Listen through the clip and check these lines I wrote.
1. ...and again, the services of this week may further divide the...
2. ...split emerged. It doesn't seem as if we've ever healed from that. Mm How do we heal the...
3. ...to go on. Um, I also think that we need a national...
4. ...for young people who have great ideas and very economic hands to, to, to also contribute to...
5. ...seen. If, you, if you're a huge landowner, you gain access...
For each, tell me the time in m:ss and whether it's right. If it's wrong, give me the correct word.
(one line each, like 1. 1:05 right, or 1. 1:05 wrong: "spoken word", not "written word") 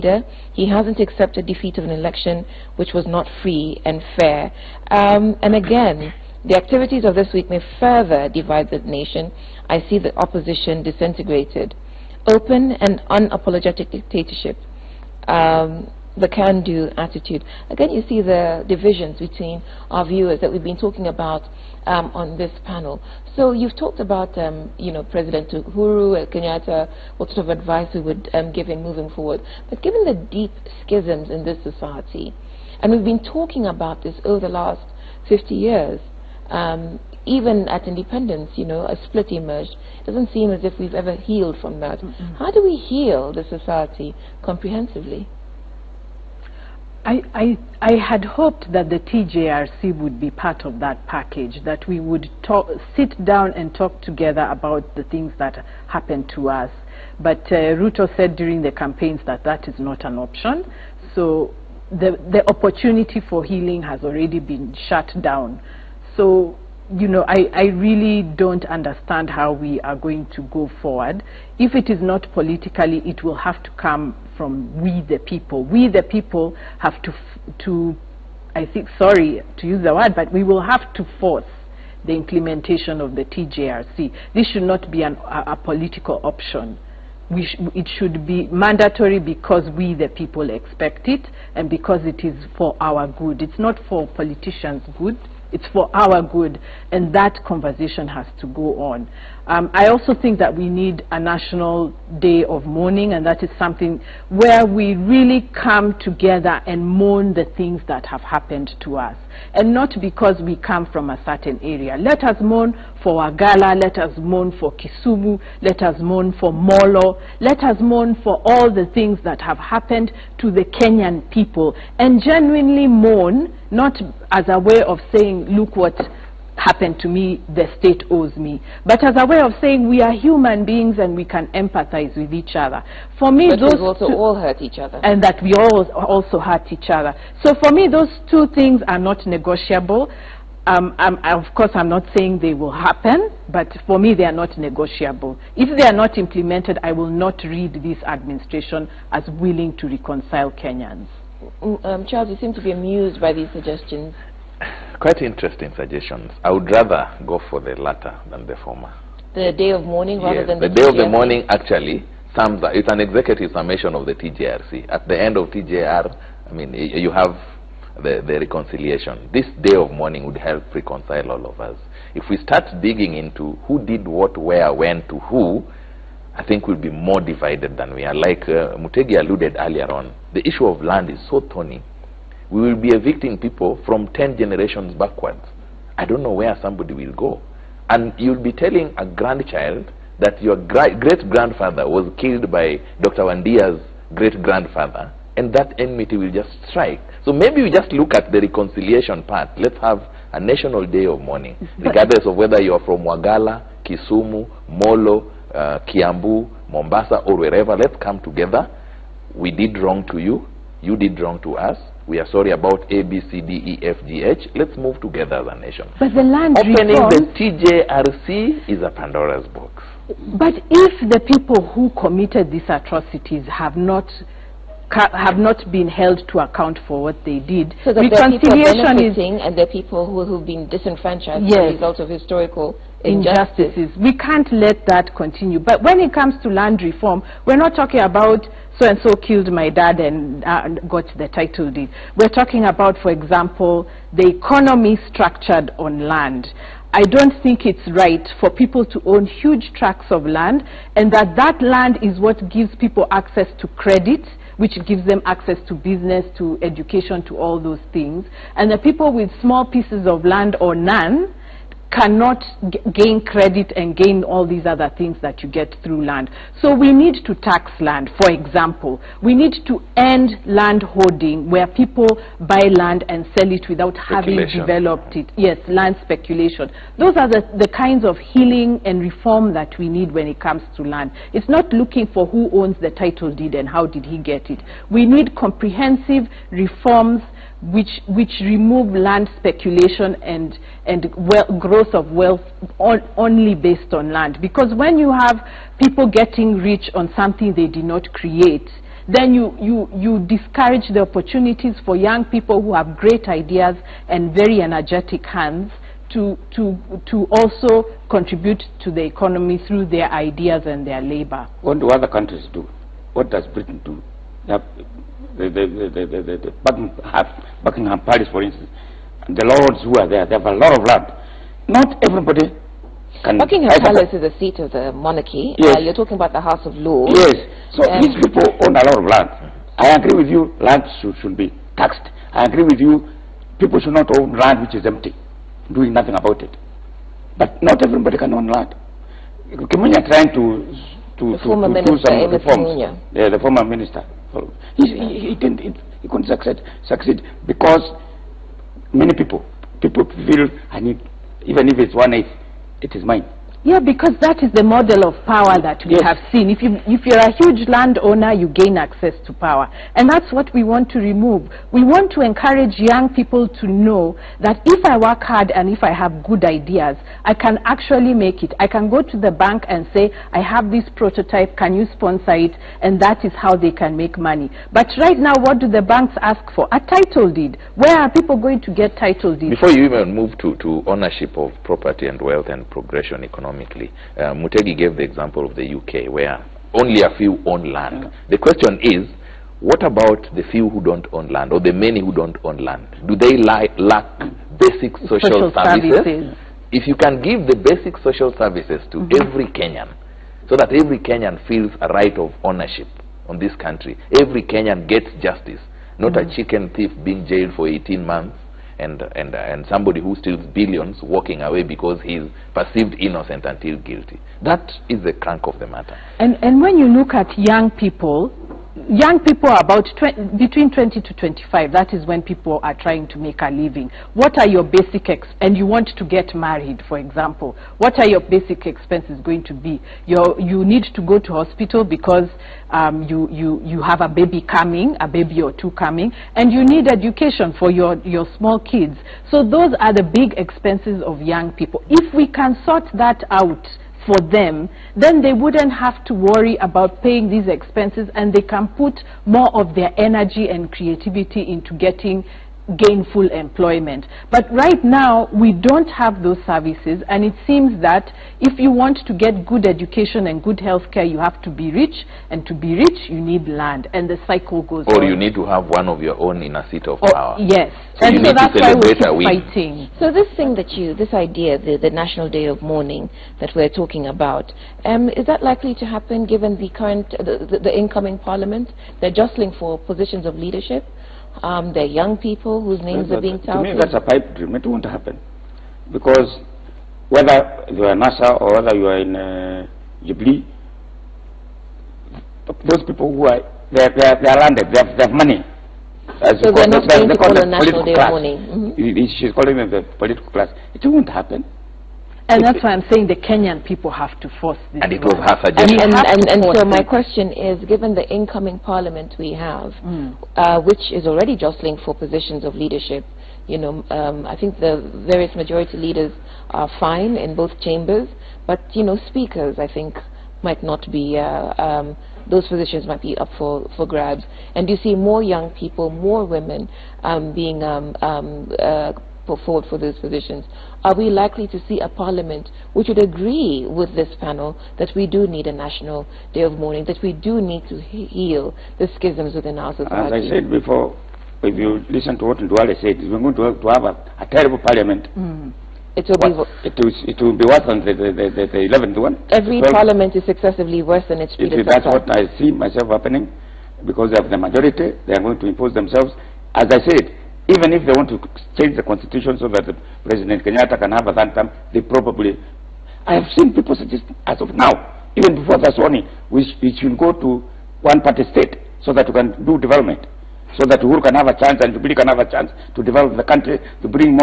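1. 0:05 wrong: "activities", not "services"
2. 0:39 right
3. 1:38 right
4. 5:01 wrong: "energetic", not "economic"
5. 5:56 right.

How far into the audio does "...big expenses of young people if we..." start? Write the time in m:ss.
7:20.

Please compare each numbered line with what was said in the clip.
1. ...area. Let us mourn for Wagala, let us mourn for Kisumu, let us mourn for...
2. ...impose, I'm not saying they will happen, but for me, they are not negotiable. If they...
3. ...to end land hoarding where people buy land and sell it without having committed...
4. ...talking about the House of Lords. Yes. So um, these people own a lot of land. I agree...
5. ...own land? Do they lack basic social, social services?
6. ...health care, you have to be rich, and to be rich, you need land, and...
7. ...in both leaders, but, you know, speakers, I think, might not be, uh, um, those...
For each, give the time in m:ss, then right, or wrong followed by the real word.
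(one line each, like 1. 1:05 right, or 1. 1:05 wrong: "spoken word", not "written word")
1. 1:51 right
2. 2:21 wrong: "course", not "impose"
3. 4:29 wrong: "developed", not "committed"
4. 5:25 right
5. 6:32 right
6. 7:40 right
7. 8:37 wrong: "chambers", not "leaders".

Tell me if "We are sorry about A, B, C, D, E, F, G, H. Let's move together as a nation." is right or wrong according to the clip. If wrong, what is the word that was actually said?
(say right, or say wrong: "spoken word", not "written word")
right.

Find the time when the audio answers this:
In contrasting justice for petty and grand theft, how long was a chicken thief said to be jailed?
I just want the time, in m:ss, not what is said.
6:47.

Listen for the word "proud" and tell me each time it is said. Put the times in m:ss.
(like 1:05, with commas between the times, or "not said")
not said.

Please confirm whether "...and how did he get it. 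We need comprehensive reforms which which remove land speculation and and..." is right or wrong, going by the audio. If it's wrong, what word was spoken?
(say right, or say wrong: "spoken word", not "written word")
right.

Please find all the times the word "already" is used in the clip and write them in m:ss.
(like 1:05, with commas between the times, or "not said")
1:04, 8:31.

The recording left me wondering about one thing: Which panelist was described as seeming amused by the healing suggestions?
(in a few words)
Charles.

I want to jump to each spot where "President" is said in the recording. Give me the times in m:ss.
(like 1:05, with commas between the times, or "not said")
0:25, 9:20.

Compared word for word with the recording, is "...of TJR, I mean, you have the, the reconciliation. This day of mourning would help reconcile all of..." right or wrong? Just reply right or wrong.
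right.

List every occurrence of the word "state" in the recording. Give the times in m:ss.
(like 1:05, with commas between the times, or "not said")
2:07, 9:28.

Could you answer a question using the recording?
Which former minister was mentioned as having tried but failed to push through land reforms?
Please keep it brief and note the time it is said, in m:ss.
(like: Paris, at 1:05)
Kimonya, at 5:39.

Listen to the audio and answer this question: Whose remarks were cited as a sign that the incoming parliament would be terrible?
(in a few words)
Duale.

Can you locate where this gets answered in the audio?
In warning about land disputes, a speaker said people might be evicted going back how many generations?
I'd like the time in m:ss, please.
3:04.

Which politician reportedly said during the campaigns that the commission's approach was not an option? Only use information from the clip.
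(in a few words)
Ruto.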